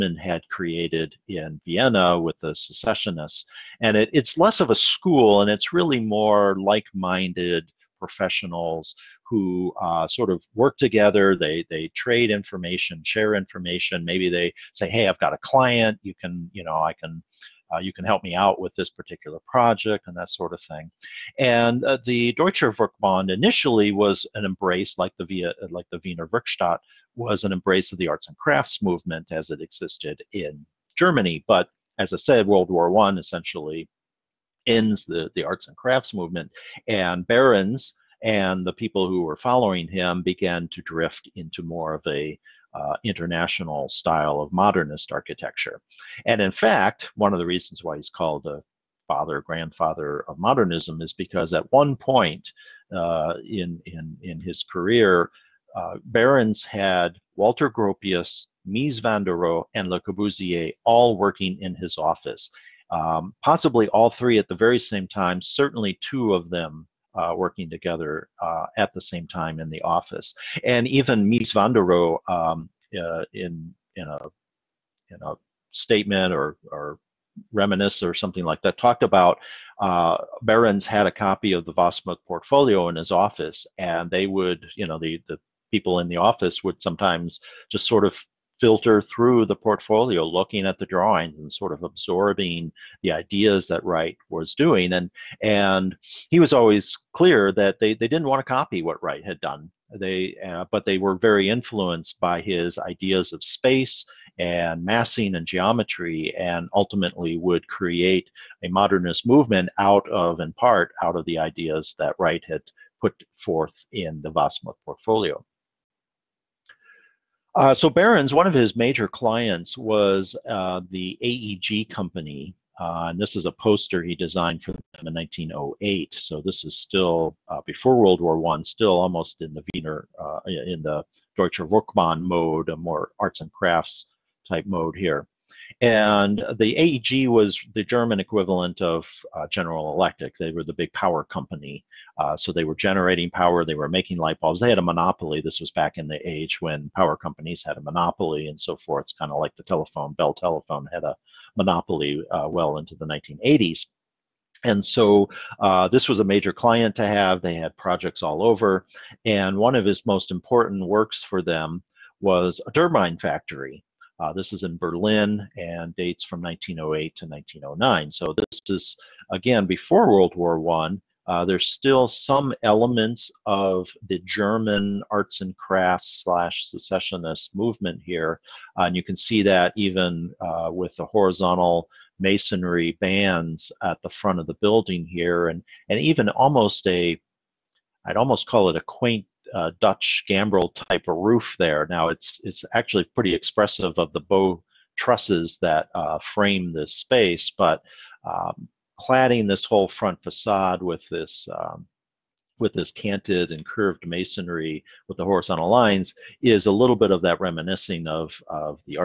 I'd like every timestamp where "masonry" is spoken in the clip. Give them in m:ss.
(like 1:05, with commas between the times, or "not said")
3:02, 3:24.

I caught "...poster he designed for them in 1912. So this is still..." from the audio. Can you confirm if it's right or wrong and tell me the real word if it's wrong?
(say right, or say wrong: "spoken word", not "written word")
wrong: "1908", not "1912".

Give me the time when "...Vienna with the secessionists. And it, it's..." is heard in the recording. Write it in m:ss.
0:01.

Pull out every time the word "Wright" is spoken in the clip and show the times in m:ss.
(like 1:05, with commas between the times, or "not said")
1:33, 1:39, 1:52.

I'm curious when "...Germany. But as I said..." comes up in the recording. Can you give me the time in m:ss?
0:30.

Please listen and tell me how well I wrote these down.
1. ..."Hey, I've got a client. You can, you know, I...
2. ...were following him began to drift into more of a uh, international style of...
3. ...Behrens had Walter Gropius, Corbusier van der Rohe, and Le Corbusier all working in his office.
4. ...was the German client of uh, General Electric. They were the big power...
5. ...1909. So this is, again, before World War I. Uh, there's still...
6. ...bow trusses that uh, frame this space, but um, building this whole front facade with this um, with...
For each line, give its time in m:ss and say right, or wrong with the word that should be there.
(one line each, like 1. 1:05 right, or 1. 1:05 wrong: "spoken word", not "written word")
1. 0:14 right
2. 0:39 right
3. 0:56 wrong: "Mies", not "Corbusier"
4. 2:17 wrong: "equivalent", not "client"
5. 2:47 right
6. 3:14 wrong: "cladding", not "building".